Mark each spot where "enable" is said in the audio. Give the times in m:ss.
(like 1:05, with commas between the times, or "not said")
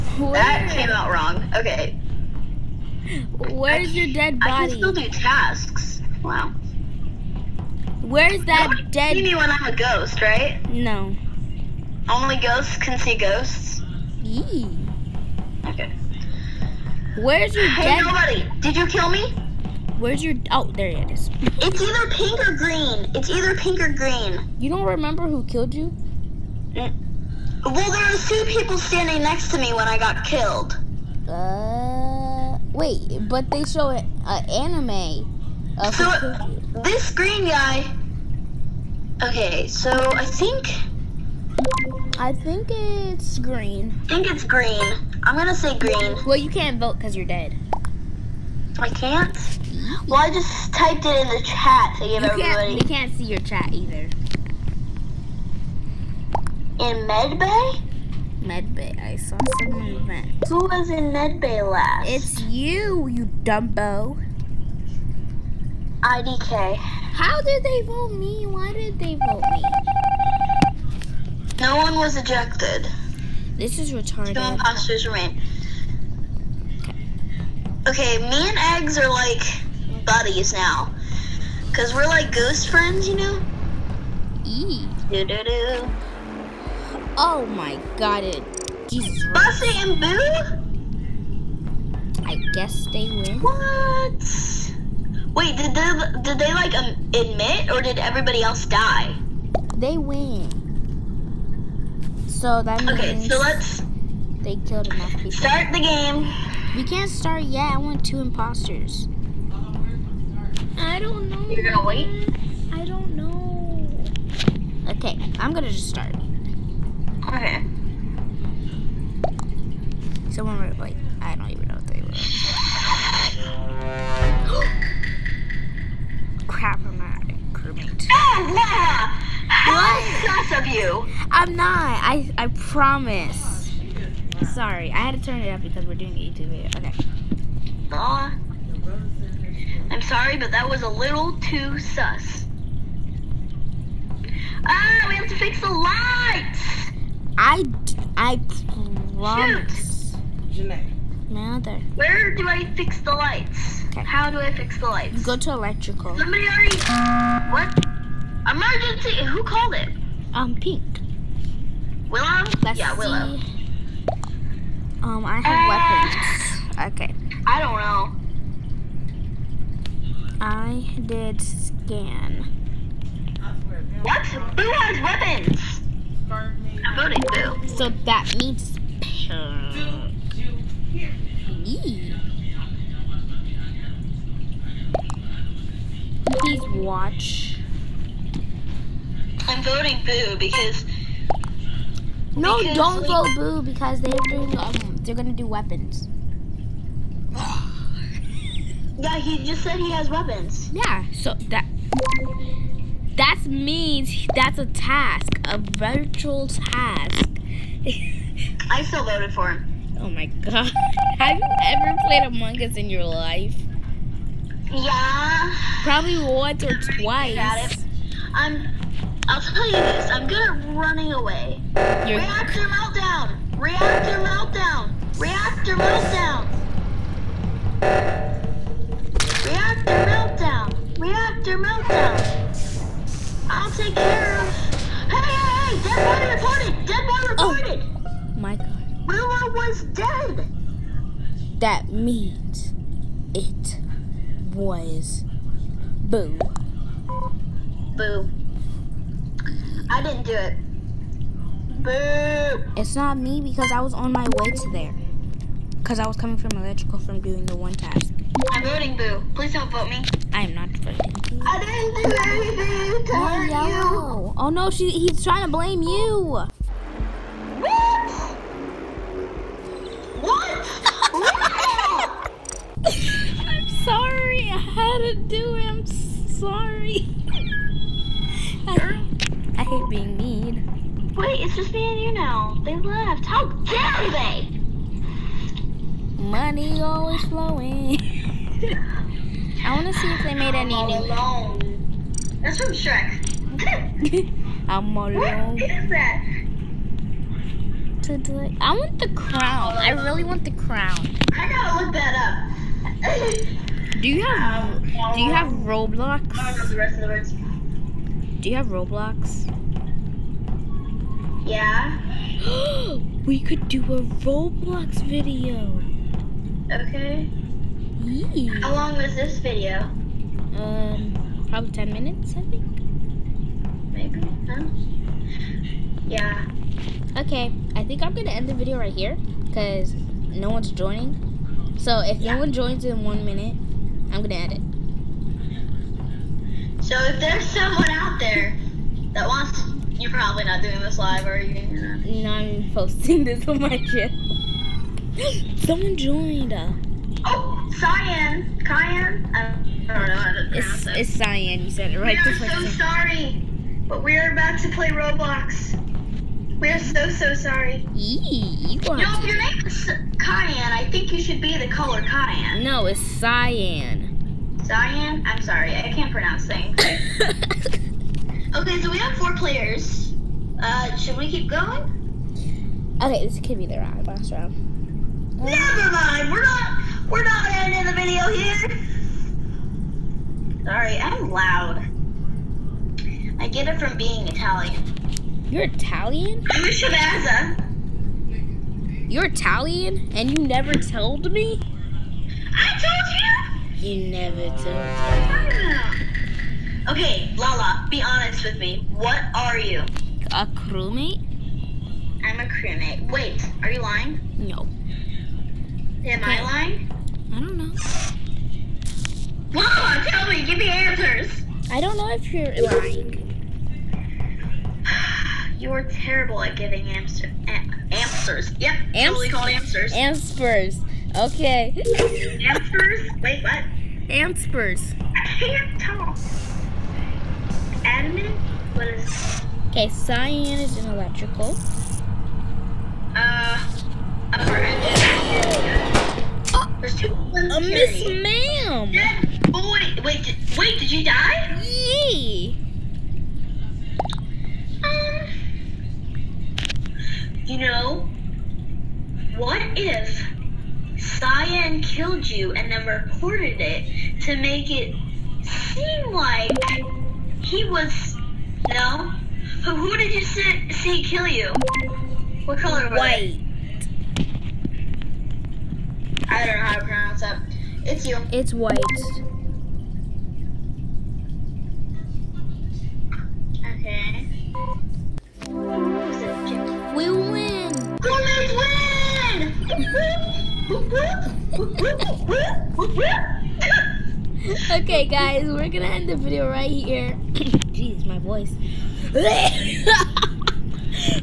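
not said.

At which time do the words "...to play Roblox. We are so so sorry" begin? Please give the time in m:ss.
5:54.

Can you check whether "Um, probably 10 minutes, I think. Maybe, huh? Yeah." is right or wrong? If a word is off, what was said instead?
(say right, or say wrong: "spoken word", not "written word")
right.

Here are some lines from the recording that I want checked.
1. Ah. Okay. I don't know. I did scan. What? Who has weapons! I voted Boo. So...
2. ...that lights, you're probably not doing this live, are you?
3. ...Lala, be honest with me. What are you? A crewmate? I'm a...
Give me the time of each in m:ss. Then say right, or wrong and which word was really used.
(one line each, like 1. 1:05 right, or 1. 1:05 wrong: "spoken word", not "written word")
1. 2:46 right
2. 5:39 wrong: "wants", not "lights"
3. 6:37 right.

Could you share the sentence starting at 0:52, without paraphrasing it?
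Can't, we can't see your chat either.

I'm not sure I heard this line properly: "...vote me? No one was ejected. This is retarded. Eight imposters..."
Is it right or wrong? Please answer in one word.
wrong.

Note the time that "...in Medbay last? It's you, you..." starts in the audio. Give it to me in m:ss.
1:00.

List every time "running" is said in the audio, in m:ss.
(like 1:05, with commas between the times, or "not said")
3:40.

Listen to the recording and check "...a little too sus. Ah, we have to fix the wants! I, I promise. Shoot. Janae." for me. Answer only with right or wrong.
wrong.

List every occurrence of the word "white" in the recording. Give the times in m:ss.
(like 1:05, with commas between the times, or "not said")
7:42, 7:48.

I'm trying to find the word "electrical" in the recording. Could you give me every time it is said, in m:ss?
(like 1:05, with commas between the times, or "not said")
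2:35, 4:16, 7:10.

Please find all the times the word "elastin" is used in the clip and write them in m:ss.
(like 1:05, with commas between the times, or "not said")
not said.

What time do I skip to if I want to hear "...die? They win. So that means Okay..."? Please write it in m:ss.
1:38.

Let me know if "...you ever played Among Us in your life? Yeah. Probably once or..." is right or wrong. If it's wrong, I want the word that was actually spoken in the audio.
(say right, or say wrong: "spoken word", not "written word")
right.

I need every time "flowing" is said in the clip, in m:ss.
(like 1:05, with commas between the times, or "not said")
4:47.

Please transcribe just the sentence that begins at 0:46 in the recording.
Well, you can't vote because you're dead.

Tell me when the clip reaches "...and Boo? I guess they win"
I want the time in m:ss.
1:29.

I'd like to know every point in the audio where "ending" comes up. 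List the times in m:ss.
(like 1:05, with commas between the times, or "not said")
6:17.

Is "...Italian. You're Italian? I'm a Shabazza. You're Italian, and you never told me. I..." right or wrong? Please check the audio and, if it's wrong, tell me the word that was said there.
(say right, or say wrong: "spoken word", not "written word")
right.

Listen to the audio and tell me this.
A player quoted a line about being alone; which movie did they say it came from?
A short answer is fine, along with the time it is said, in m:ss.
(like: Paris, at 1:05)
Shrek, at 4:52.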